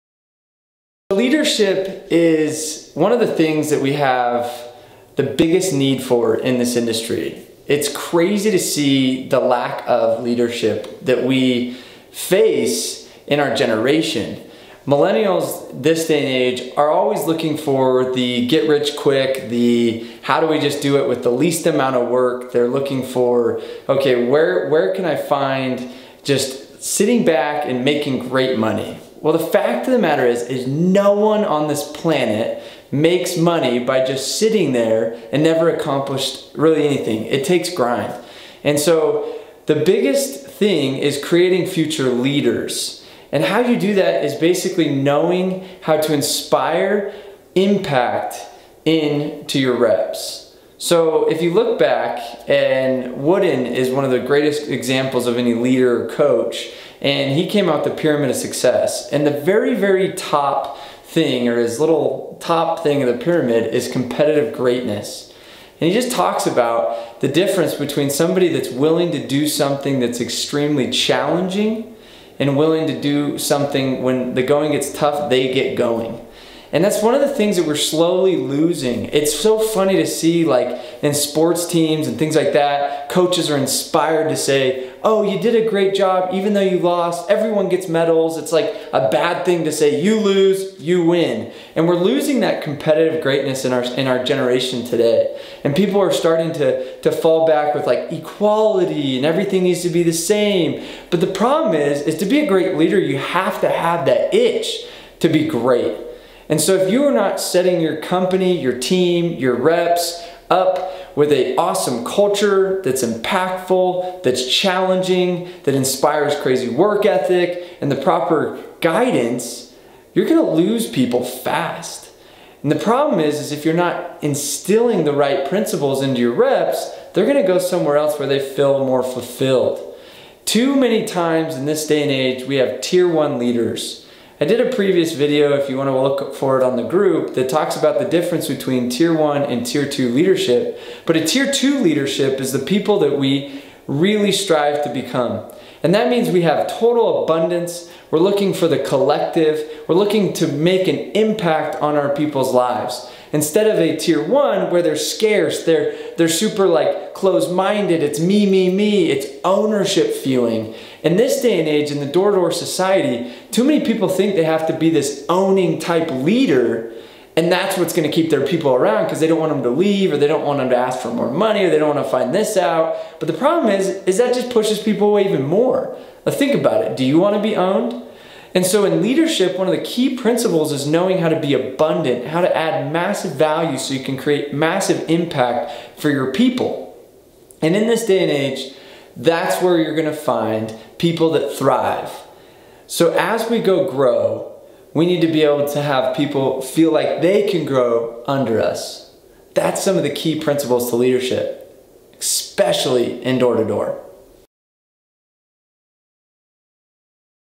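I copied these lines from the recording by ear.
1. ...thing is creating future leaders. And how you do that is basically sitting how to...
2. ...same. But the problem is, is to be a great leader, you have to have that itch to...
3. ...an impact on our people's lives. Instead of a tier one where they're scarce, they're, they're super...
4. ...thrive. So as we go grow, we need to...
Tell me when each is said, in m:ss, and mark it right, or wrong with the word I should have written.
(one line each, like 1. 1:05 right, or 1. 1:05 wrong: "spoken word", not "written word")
1. 0:40 wrong: "knowing", not "sitting"
2. 1:40 right
3. 2:30 right
4. 3:11 right.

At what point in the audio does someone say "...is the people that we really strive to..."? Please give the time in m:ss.
2:22.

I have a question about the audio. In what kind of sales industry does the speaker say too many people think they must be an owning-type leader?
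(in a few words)
Door-to-door.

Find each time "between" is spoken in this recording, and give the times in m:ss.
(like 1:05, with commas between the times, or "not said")
1:07, 2:18.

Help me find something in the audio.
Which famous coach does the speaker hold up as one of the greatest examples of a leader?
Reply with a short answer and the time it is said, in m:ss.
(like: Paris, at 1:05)
John Wooden, at 0:52.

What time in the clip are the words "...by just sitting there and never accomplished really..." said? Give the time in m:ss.
0:33.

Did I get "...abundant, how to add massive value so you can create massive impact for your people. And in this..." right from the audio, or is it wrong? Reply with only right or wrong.
right.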